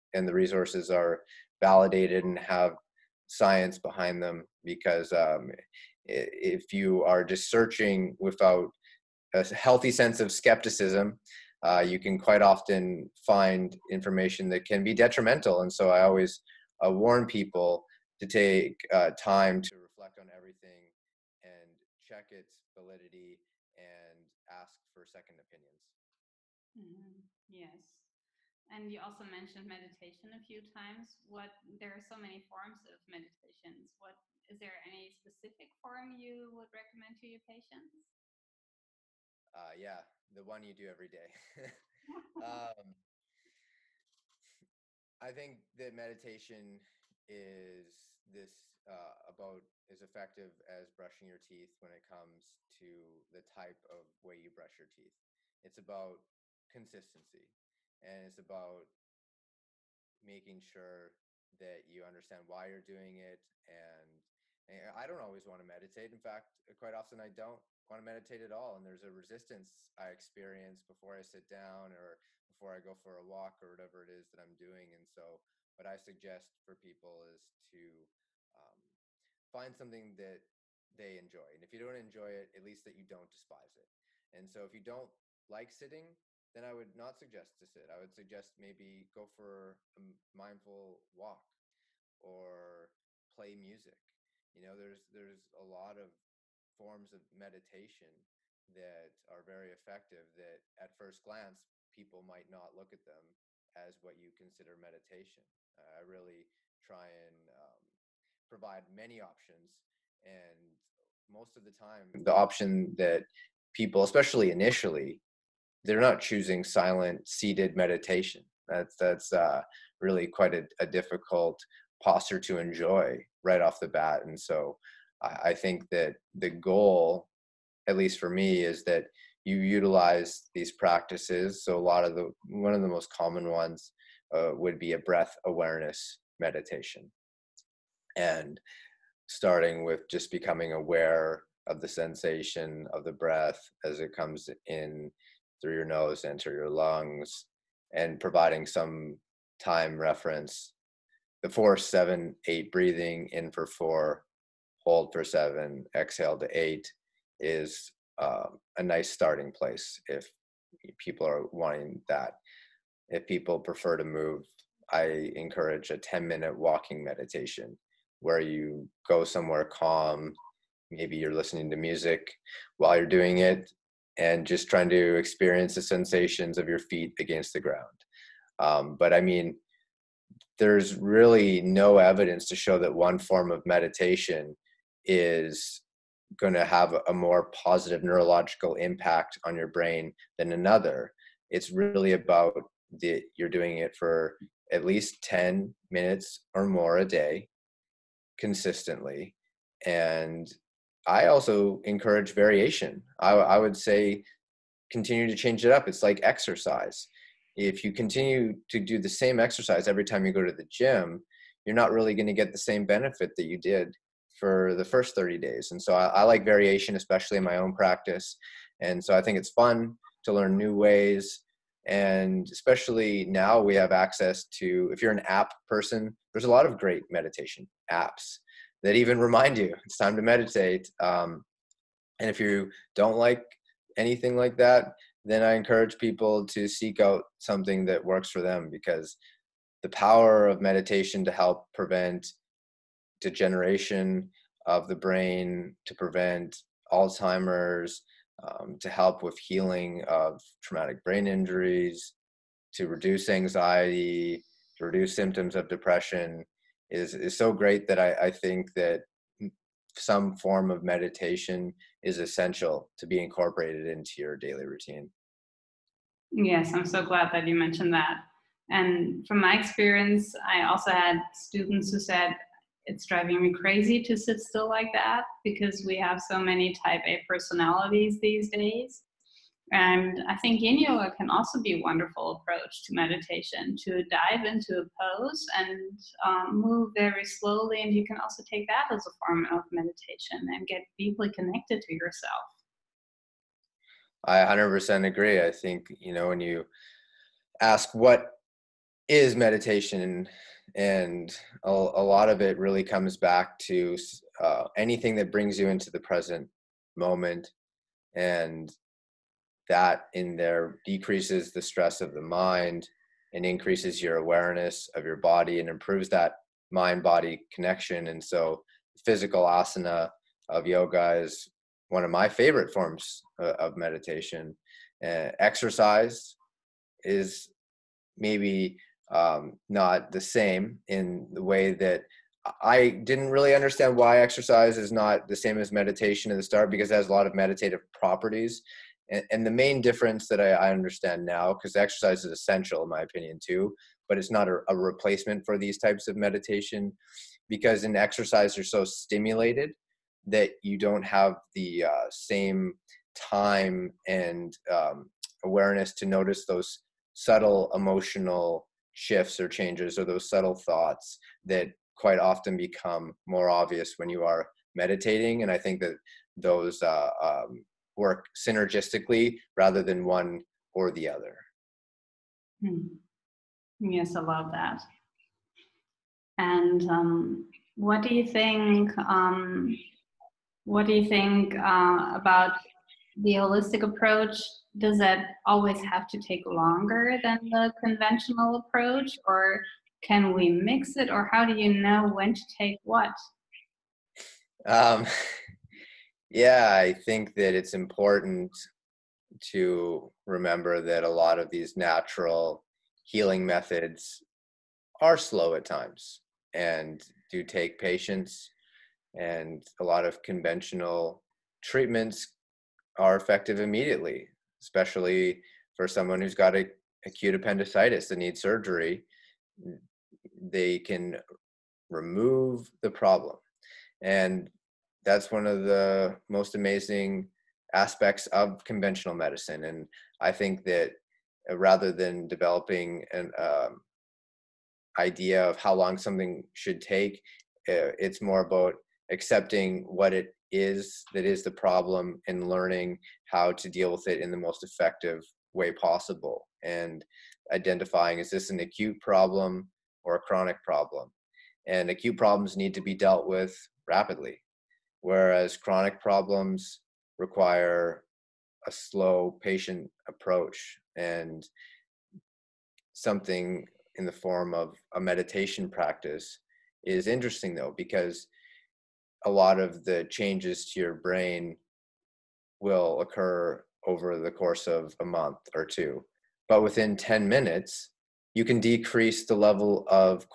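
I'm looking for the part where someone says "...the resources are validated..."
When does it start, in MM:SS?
00:00.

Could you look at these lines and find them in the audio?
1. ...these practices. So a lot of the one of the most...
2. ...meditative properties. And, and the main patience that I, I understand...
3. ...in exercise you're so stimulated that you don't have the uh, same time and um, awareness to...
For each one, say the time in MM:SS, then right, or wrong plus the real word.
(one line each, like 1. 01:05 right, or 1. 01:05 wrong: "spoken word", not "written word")
1. 02:10 right
2. 05:37 wrong: "difference", not "patience"
3. 05:47 right.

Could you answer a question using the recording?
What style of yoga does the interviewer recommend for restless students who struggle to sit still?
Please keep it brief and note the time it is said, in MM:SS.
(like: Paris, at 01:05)
yin yoga, at 04:40.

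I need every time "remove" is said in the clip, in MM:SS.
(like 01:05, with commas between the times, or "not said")
07:01.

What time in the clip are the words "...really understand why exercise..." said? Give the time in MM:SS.
05:33.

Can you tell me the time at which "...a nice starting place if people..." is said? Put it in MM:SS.
02:38.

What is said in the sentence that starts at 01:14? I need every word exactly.
And so, what I suggest for people is to um, find something that they enjoy.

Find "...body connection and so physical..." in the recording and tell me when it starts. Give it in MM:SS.
05:17.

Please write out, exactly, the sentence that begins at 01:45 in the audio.
I really try and um, provide many options.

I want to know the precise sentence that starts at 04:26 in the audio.
Yes, I'm so glad that you mentioned that.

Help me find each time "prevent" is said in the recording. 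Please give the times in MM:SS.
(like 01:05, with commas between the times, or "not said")
04:01, 04:05.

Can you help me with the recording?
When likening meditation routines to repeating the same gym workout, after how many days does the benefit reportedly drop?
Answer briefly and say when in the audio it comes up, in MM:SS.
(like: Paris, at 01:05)
30, at 03:35.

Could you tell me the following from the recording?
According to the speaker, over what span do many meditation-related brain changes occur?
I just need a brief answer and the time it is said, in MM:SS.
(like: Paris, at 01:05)
a month or two, at 07:55.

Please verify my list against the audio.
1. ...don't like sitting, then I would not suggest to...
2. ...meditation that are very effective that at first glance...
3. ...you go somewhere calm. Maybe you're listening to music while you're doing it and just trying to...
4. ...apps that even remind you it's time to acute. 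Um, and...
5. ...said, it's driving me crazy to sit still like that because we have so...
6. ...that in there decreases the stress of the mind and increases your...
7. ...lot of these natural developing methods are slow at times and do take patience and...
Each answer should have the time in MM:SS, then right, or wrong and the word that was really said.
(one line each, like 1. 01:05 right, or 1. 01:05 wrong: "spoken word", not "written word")
1. 01:24 right
2. 01:37 right
3. 02:48 right
4. 03:47 wrong: "meditate", not "acute"
5. 04:31 right
6. 05:09 right
7. 06:41 wrong: "healing", not "developing".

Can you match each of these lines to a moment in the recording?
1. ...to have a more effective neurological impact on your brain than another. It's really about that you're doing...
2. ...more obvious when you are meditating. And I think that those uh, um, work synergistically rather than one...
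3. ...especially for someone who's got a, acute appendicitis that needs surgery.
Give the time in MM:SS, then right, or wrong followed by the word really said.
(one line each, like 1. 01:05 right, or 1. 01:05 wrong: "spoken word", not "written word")
1. 03:06 wrong: "positive", not "effective"
2. 06:03 right
3. 06:54 right.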